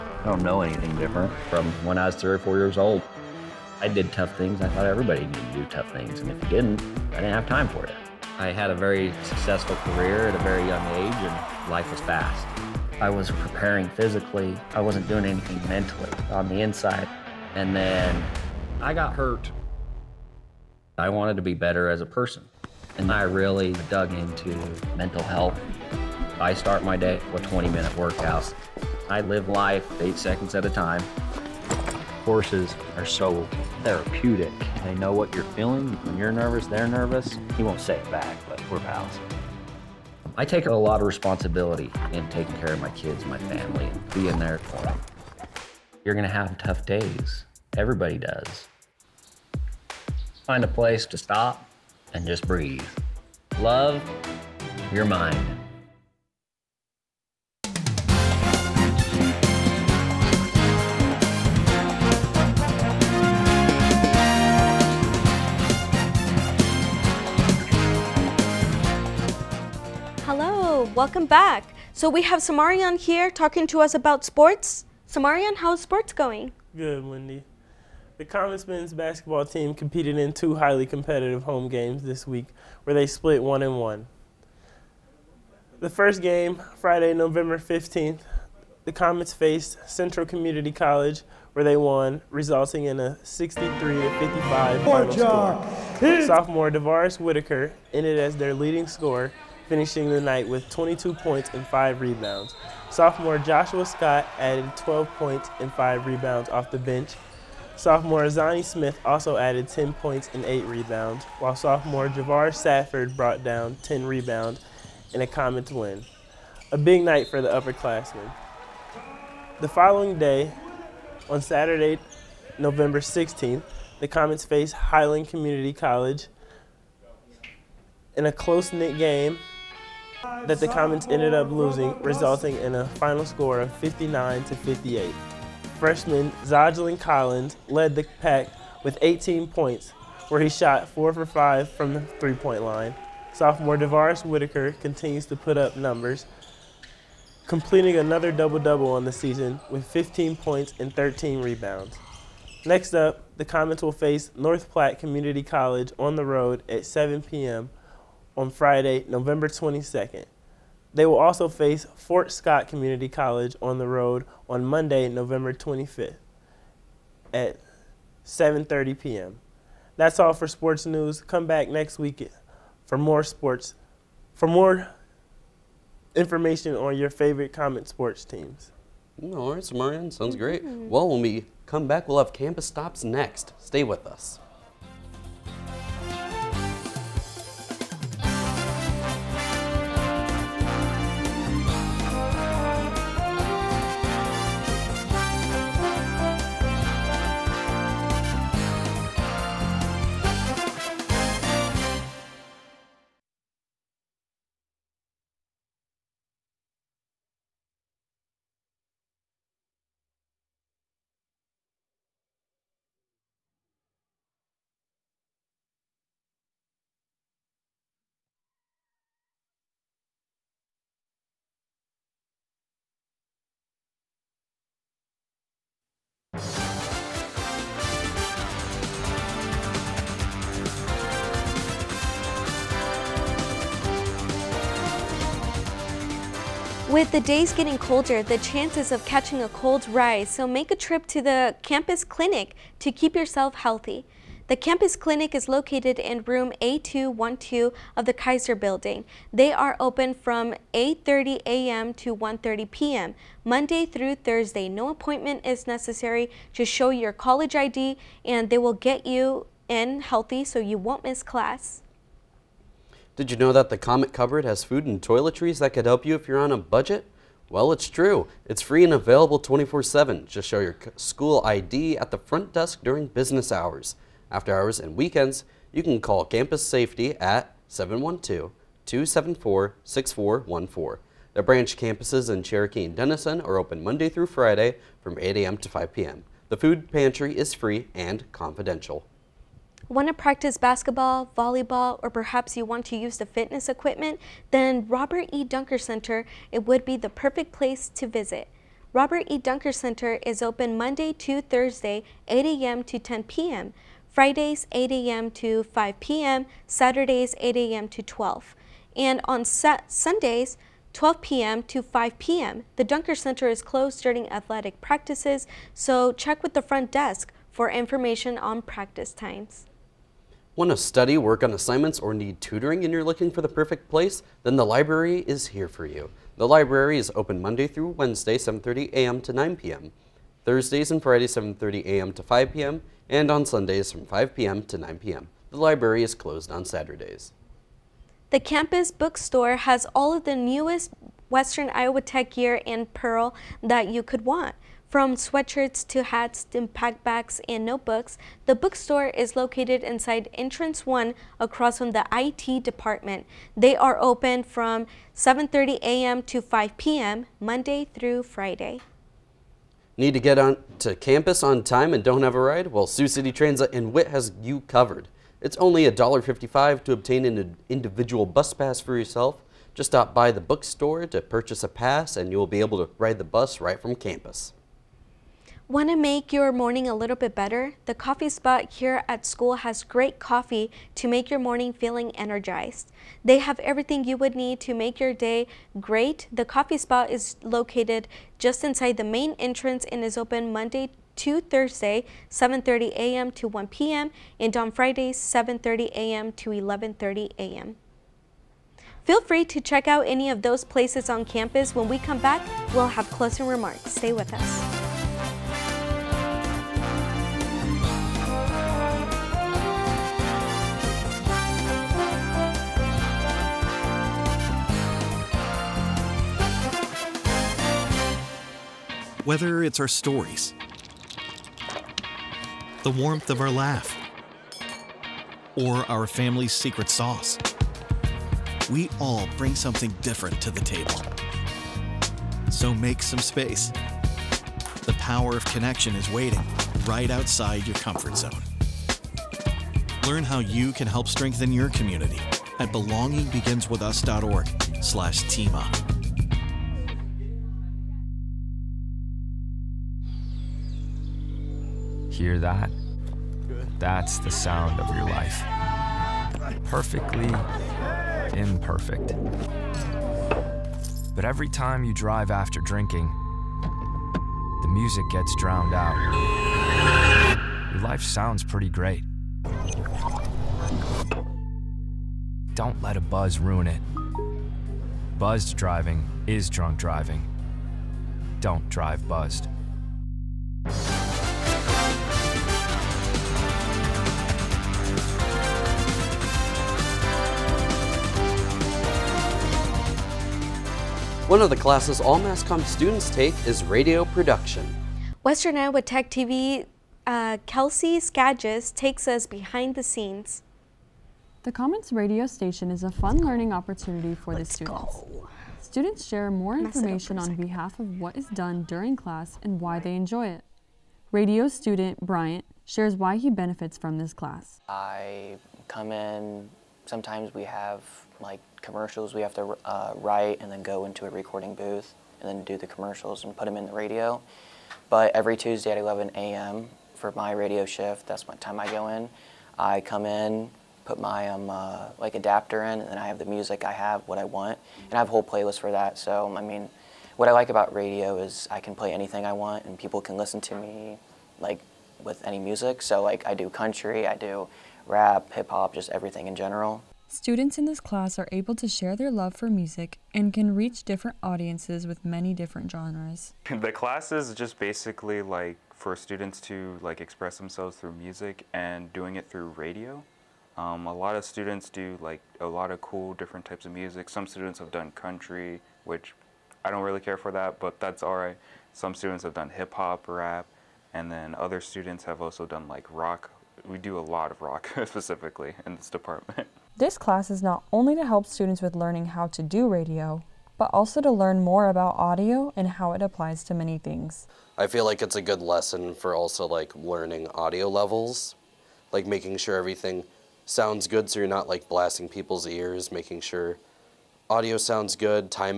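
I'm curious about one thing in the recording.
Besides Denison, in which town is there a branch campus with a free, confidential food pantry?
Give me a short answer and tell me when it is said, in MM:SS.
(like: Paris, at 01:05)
Cherokee, at 04:42.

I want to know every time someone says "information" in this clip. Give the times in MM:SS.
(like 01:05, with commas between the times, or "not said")
02:56, 05:17, 08:26.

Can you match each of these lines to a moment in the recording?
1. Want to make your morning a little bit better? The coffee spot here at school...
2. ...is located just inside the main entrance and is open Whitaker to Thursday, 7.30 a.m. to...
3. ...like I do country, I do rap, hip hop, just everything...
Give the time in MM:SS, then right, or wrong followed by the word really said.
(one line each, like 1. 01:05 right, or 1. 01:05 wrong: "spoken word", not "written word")
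1. 06:15 right
2. 06:27 wrong: "Monday", not "Whitaker"
3. 09:03 right.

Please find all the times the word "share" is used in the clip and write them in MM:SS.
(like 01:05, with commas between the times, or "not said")
08:26, 08:32, 09:08.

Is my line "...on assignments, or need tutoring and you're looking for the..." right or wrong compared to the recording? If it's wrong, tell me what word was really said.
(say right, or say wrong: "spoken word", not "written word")
right.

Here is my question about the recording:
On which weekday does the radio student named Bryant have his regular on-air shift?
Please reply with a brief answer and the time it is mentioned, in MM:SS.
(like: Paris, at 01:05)
Tuesday, at 08:45.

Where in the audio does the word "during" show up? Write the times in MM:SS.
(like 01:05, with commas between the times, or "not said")
04:32, 05:14, 08:28.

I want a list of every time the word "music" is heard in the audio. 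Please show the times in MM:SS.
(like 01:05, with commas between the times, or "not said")
07:44, 08:53, 09:02, 09:09, 09:17, 09:23.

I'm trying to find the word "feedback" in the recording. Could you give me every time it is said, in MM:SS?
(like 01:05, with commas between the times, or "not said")
not said.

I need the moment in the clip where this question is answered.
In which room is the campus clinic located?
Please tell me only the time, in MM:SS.
04:06.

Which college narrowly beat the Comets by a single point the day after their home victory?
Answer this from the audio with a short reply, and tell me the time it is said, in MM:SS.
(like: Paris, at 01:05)
Highland Community College, at 02:04.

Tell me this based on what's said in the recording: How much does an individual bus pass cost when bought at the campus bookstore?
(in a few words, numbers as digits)
$1.55.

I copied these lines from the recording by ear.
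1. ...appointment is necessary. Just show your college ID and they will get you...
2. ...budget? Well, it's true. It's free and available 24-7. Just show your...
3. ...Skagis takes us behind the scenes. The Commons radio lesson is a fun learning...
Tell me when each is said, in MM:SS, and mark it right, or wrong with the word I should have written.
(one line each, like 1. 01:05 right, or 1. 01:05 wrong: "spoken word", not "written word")
1. 04:14 right
2. 04:26 right
3. 08:17 wrong: "station", not "lesson".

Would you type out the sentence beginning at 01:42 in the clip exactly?
Sophomore Joshua Scott added 12 points and 5 rebounds off the bench.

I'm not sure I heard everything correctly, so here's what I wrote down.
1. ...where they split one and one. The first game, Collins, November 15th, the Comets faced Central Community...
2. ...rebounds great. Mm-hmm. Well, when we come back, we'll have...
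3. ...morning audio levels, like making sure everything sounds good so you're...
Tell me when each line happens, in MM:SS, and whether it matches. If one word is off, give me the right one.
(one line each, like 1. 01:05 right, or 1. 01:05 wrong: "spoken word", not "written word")
1. 01:22 wrong: "Friday", not "Collins"
2. 03:00 wrong: "sounds", not "rebounds"
3. 09:46 wrong: "learning", not "morning".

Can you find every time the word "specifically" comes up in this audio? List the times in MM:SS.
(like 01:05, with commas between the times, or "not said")
09:34.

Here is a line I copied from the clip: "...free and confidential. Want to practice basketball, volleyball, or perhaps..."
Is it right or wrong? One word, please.
right.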